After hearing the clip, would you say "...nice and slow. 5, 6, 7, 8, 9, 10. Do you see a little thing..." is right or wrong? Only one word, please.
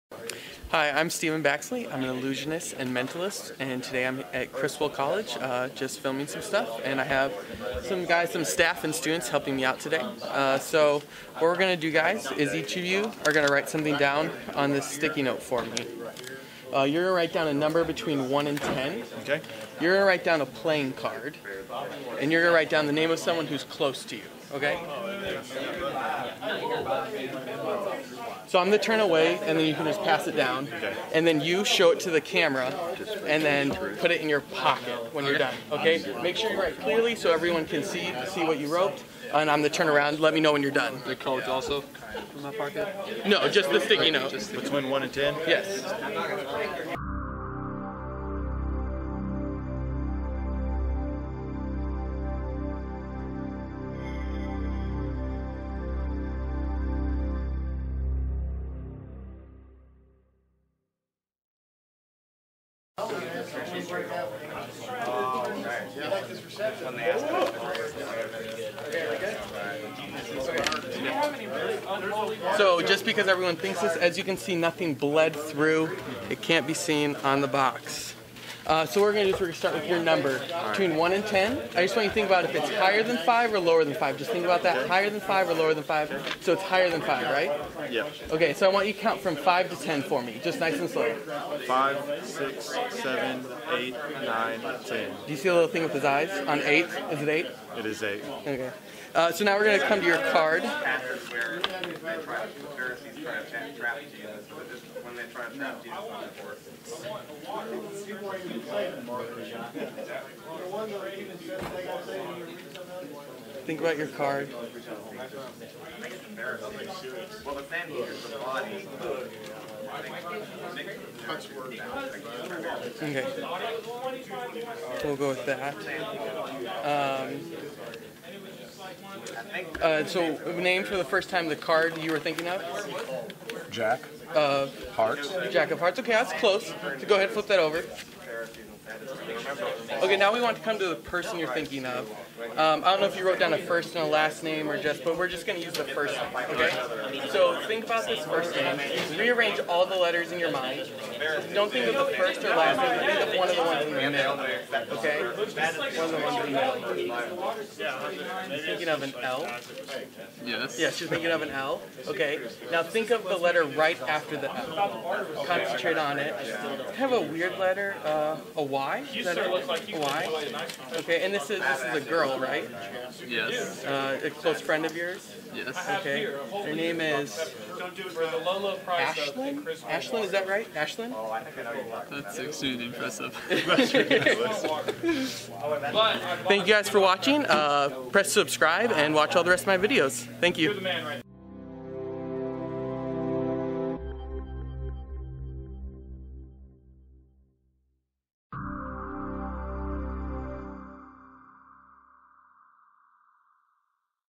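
right.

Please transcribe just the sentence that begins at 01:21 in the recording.
I just want you to think about if it's higher than 5 or lower than 5.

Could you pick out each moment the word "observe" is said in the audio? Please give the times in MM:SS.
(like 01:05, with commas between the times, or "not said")
not said.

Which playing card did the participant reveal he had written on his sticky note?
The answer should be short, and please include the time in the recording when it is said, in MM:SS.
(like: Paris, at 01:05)
Jack of Hearts, at 02:15.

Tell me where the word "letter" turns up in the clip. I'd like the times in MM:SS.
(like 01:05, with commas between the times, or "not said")
02:29, 02:43, 02:47.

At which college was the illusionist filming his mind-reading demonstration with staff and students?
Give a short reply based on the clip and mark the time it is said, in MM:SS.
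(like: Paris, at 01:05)
Criswell College, at 00:04.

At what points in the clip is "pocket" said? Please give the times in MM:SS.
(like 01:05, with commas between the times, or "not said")
00:34, 00:42.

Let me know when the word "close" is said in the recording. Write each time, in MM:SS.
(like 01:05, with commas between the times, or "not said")
00:23, 02:16, 02:54.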